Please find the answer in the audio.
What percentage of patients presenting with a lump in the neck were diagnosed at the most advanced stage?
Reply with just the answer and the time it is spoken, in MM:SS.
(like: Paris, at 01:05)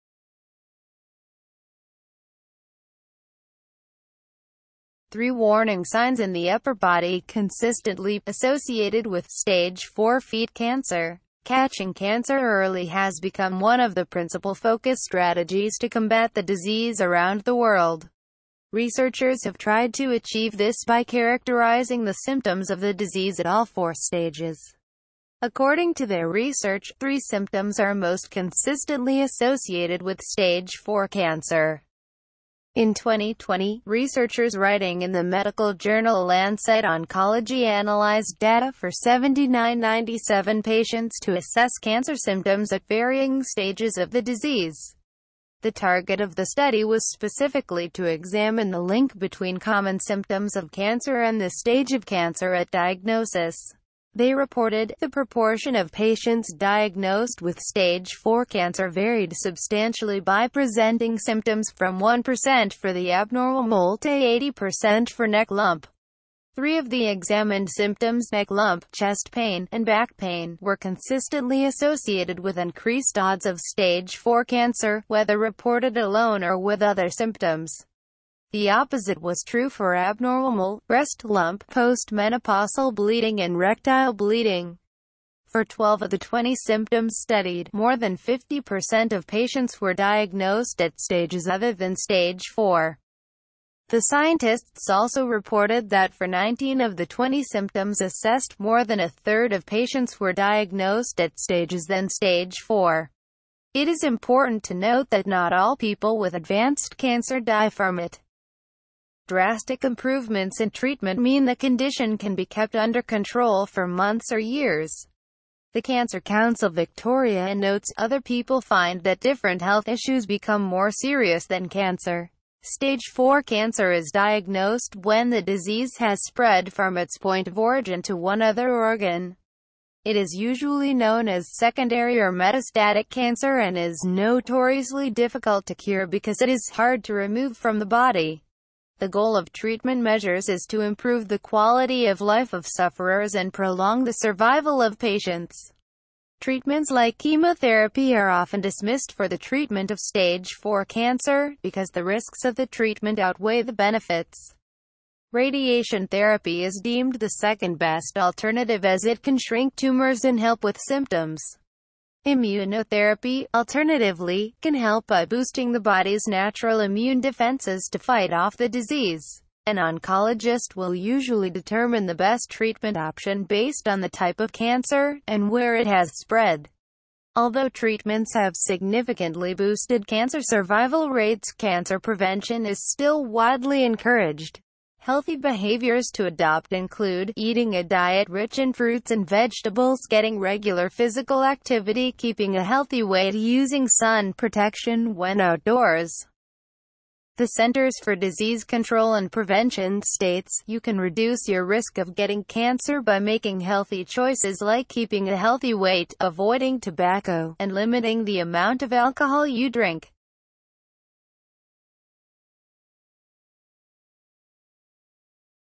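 80%, at 01:04.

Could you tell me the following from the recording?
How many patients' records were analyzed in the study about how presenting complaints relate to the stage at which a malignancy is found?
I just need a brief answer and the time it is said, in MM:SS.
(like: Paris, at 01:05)
7997, at 00:38.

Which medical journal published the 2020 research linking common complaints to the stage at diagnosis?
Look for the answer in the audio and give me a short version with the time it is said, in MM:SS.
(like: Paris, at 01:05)
Lancet Oncology, at 00:36.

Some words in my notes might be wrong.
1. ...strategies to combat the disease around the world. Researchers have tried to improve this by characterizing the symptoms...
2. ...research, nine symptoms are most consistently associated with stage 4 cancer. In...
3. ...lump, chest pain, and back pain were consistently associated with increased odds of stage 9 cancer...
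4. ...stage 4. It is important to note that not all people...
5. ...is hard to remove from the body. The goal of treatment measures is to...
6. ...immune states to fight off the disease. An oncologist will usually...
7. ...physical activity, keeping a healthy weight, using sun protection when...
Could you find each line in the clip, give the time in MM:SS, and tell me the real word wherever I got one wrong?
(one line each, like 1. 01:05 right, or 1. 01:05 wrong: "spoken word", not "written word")
1. 00:15 wrong: "achieve", not "improve"
2. 00:26 wrong: "three", not "nine"
3. 01:08 wrong: "4", not "9"
4. 01:42 right
5. 02:16 right
6. 02:46 wrong: "defenses", not "states"
7. 03:10 right.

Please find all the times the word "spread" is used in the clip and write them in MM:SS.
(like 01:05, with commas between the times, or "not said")
02:06, 02:56.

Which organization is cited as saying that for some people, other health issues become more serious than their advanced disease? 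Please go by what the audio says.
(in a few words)
Cancer Council Victoria.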